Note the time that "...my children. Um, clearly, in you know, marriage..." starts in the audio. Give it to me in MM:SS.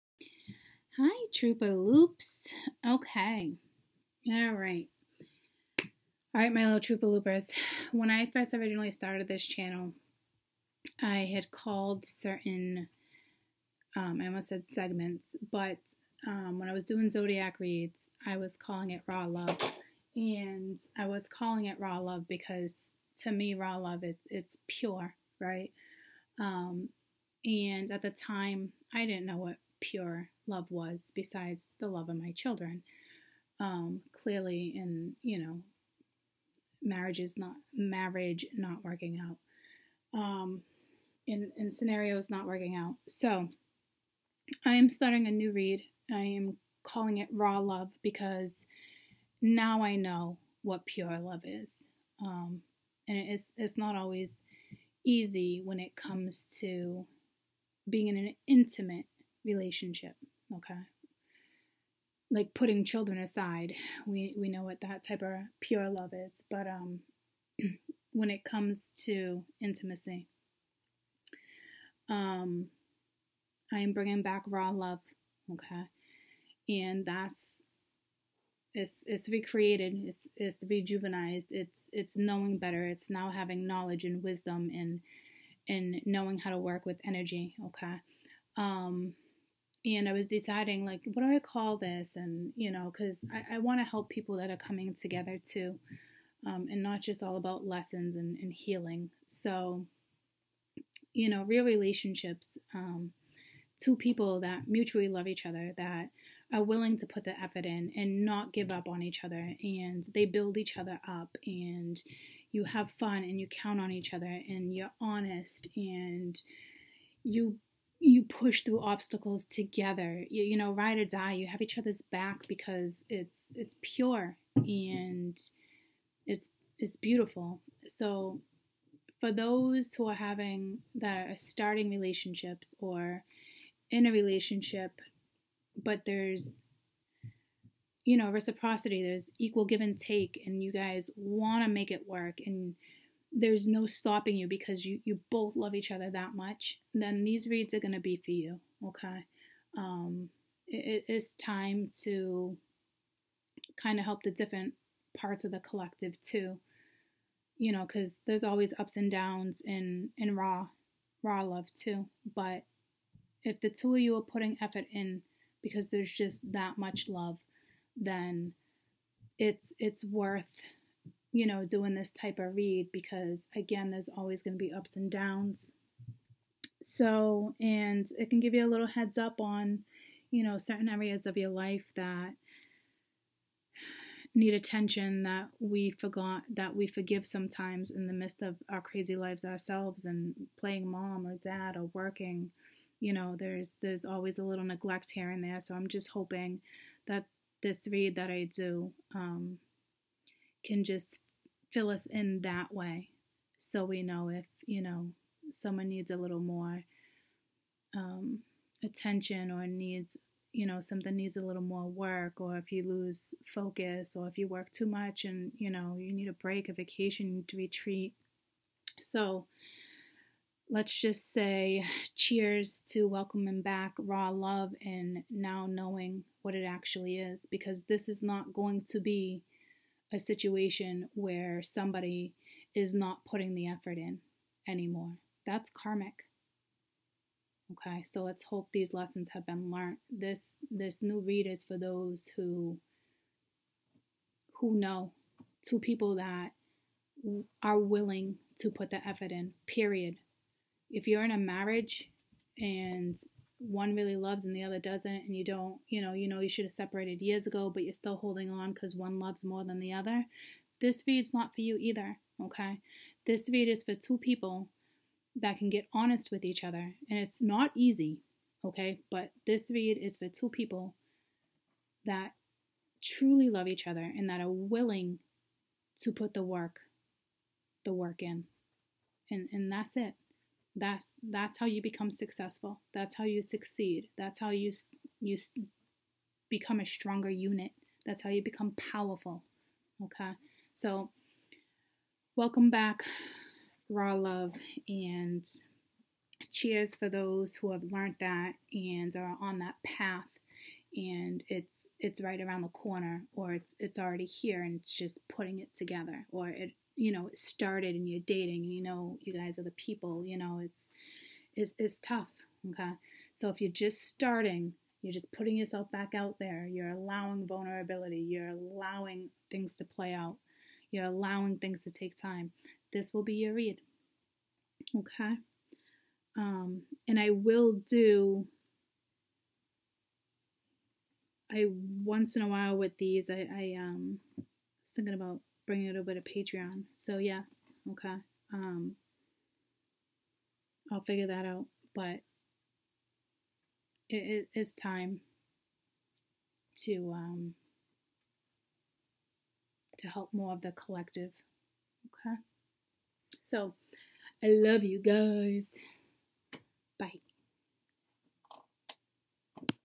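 00:32.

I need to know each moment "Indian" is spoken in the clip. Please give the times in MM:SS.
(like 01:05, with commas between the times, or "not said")
not said.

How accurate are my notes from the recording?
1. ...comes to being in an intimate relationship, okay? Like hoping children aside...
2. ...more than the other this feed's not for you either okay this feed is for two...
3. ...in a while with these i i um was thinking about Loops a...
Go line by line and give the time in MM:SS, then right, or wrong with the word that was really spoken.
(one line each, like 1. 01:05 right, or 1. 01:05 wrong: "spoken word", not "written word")
1. 00:55 wrong: "putting", not "hoping"
2. 04:19 right
3. 05:32 wrong: "Bring", not "Loops".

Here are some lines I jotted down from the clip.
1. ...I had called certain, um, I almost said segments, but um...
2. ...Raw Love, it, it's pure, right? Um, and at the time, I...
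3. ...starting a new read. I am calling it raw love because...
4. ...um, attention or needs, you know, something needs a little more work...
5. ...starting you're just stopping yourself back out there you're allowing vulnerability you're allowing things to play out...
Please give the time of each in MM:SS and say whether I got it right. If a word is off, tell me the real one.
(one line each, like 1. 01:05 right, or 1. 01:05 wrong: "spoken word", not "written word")
1. 00:11 right
2. 00:23 right
3. 00:44 right
4. 03:27 right
5. 05:14 wrong: "putting", not "stopping".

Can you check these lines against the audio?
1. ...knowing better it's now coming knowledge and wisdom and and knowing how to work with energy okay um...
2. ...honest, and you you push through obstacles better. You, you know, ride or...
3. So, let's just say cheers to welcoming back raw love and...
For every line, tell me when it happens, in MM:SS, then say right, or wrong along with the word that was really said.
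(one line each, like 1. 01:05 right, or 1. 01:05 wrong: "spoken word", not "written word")
1. 01:22 wrong: "having", not "coming"
2. 01:55 wrong: "together", not "better"
3. 03:38 right.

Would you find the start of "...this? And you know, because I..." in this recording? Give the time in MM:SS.
01:31.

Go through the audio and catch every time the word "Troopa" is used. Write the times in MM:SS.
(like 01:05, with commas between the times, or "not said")
00:01, 00:06.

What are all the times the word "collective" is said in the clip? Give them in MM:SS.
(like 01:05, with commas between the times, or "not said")
02:35, 05:50.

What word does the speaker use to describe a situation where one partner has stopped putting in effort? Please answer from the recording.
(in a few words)
karmic.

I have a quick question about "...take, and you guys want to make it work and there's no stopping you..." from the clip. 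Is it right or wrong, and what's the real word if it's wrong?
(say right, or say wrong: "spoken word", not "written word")
right.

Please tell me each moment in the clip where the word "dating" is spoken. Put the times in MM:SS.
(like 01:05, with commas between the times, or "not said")
05:08.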